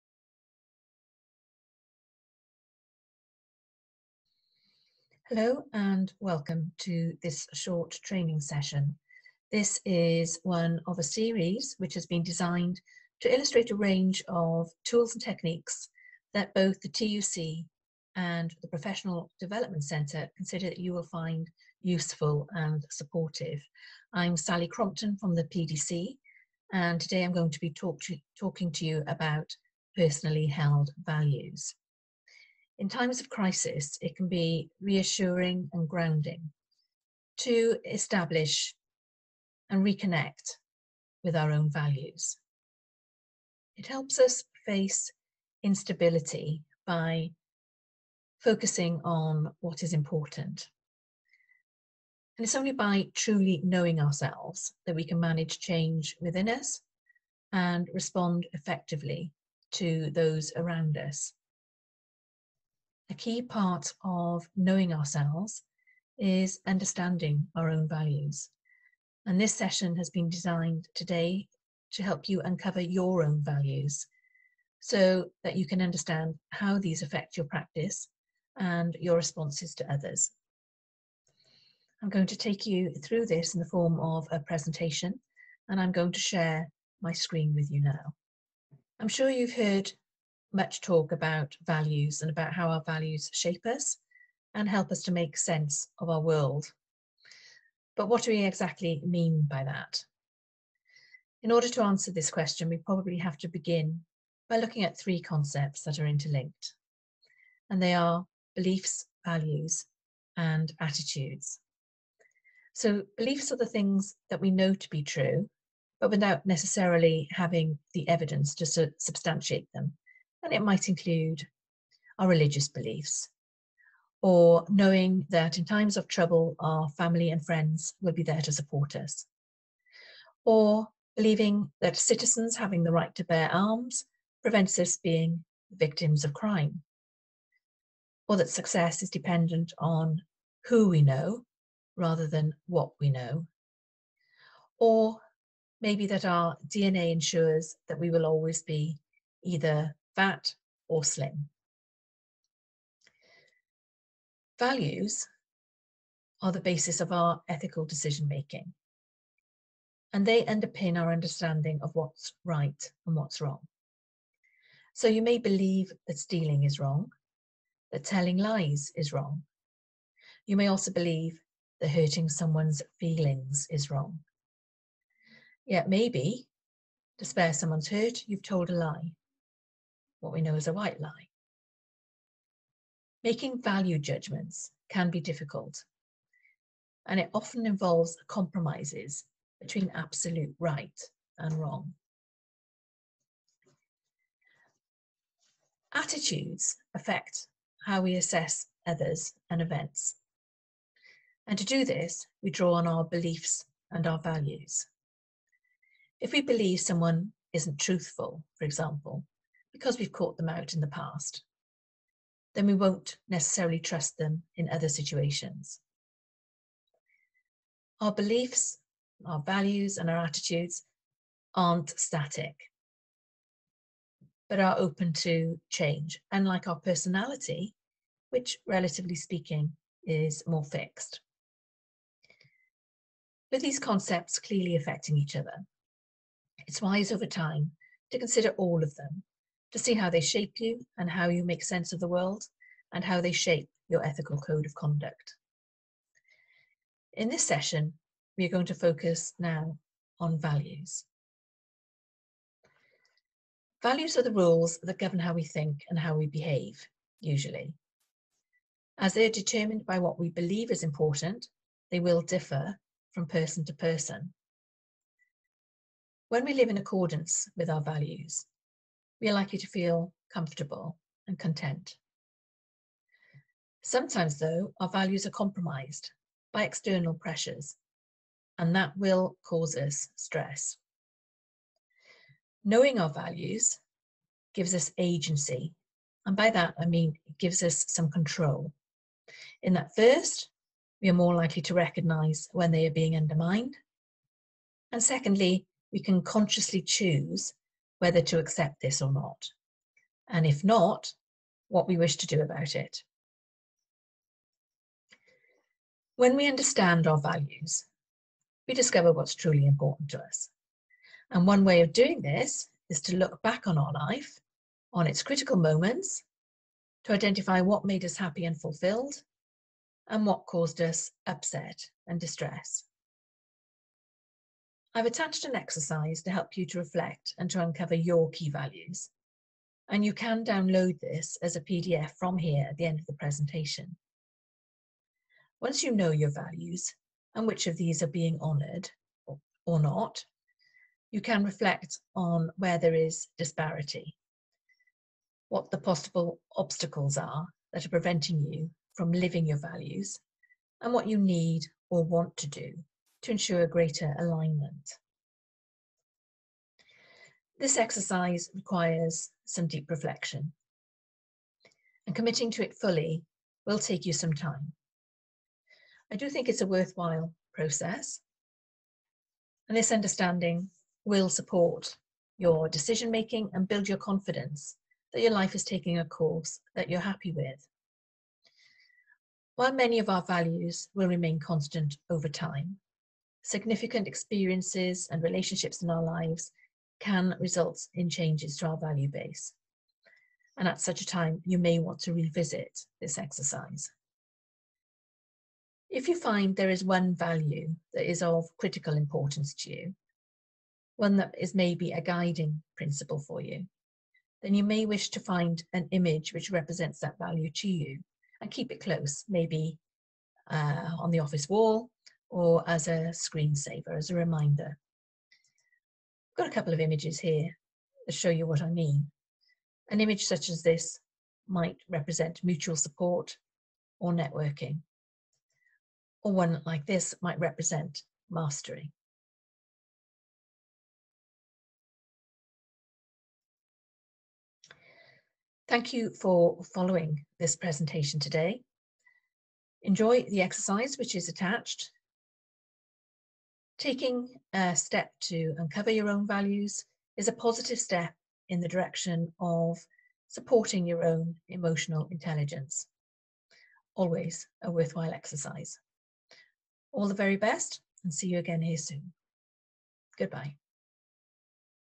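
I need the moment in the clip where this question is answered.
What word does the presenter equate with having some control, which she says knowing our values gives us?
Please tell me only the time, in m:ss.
4:44.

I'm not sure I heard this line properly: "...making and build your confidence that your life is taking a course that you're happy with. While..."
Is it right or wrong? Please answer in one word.
right.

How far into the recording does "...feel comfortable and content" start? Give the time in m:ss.
4:29.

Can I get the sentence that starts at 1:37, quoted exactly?
But what do we exactly mean by that?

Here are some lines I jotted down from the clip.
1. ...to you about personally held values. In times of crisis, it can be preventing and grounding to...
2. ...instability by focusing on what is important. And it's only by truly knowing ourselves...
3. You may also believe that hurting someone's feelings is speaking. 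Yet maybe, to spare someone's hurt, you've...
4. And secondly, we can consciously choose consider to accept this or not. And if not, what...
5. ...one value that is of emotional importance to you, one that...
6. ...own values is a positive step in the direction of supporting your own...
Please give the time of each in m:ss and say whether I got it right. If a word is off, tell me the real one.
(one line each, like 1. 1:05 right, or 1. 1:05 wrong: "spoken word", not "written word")
1. 0:28 wrong: "reassuring", not "preventing"
2. 0:45 right
3. 2:50 wrong: "wrong", not "speaking"
4. 4:54 wrong: "whether", not "consider"
5. 6:36 wrong: "critical", not "emotional"
6. 7:26 right.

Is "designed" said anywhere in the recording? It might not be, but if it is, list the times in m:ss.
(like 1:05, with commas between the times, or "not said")
0:12, 1:10.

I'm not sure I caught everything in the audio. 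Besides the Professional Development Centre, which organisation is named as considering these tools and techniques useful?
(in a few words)
TUC.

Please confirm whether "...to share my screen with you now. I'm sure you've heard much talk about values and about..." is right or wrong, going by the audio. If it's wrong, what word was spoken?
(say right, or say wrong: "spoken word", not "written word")
right.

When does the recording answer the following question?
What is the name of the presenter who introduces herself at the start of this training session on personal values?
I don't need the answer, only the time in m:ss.
0:24.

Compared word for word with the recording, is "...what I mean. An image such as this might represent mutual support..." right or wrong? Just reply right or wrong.
right.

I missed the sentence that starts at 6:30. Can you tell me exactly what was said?
And at such a time, you may want to revisit this exercise.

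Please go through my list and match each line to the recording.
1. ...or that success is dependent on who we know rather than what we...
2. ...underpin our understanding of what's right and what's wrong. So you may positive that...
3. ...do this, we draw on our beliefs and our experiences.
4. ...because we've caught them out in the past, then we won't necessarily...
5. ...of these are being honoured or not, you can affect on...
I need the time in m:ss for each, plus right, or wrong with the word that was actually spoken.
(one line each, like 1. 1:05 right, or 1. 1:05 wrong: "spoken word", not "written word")
1. 2:18 right
2. 2:40 wrong: "believe", not "positive"
3. 3:21 wrong: "values", not "experiences"
4. 3:29 right
5. 5:37 wrong: "reflect", not "affect".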